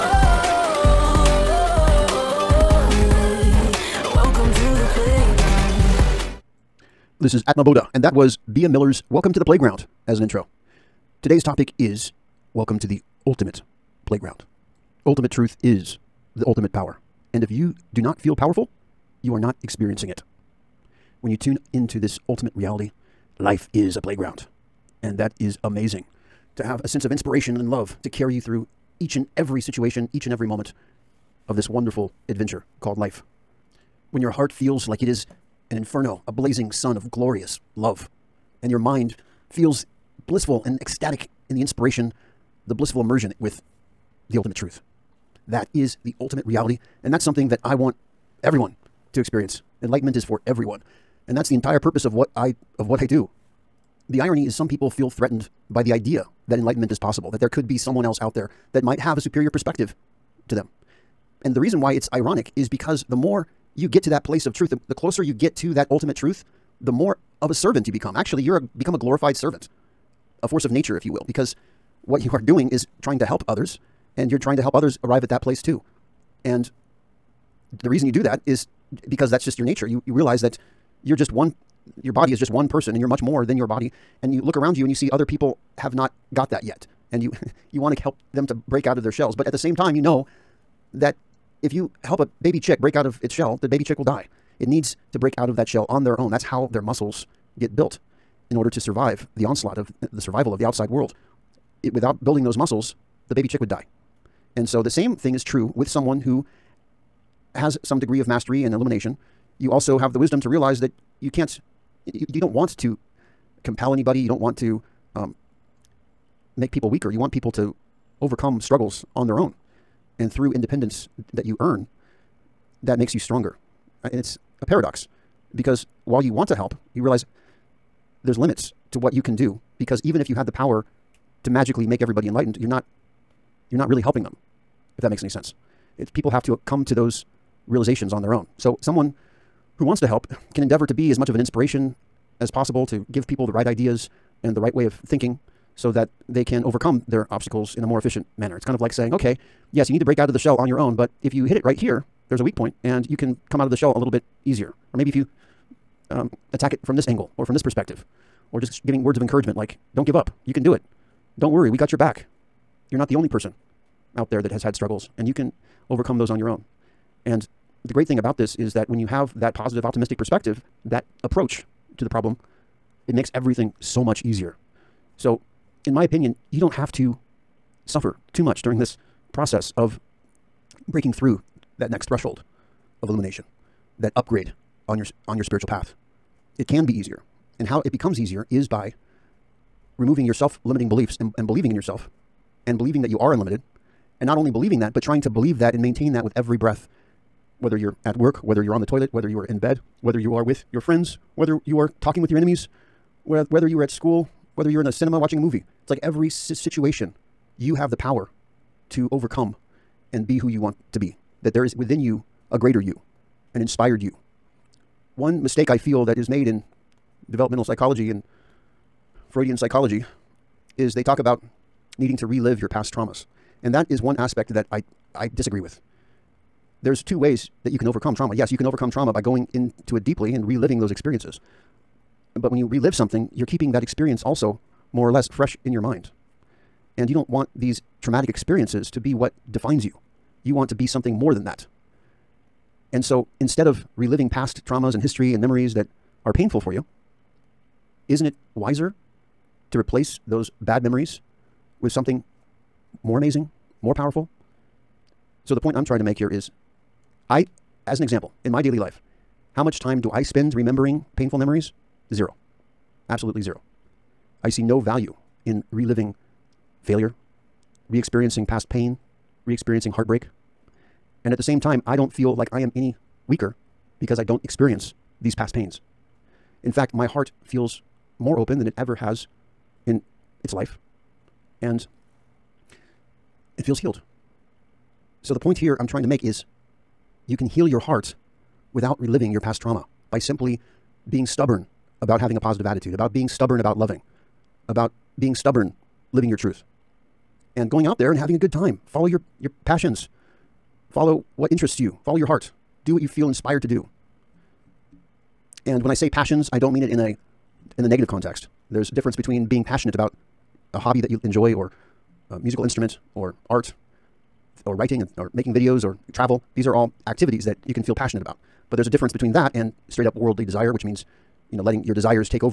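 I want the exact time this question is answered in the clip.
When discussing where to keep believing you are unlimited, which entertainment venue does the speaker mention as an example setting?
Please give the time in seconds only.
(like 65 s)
204 s.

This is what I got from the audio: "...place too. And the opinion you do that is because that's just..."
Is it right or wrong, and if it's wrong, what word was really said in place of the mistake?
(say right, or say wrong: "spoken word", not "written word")
wrong: "reason", not "opinion".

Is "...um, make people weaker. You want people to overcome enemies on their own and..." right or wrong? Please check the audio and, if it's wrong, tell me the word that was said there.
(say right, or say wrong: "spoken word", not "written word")
wrong: "struggles", not "enemies".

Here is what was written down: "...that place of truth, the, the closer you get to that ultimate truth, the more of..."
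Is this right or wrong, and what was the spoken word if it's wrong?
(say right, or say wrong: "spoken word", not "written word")
right.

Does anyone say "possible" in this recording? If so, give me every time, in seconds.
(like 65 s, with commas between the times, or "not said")
56 s, 142 s.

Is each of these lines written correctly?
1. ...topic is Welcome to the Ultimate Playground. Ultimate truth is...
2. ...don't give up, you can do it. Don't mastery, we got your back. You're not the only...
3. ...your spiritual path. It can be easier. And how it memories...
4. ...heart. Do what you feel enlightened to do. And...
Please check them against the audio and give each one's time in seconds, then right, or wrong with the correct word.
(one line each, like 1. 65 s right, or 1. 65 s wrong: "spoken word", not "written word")
1. 11 s right
2. 159 s wrong: "worry", not "mastery"
3. 185 s wrong: "becomes", not "memories"
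4. 302 s wrong: "inspired", not "enlightened".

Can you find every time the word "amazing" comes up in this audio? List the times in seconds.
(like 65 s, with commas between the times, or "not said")
25 s, 253 s.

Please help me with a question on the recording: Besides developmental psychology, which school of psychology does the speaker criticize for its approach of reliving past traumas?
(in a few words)
Freudian psychology.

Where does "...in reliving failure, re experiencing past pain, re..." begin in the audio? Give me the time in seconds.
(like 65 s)
265 s.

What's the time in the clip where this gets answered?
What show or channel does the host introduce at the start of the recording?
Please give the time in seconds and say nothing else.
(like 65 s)
7 s.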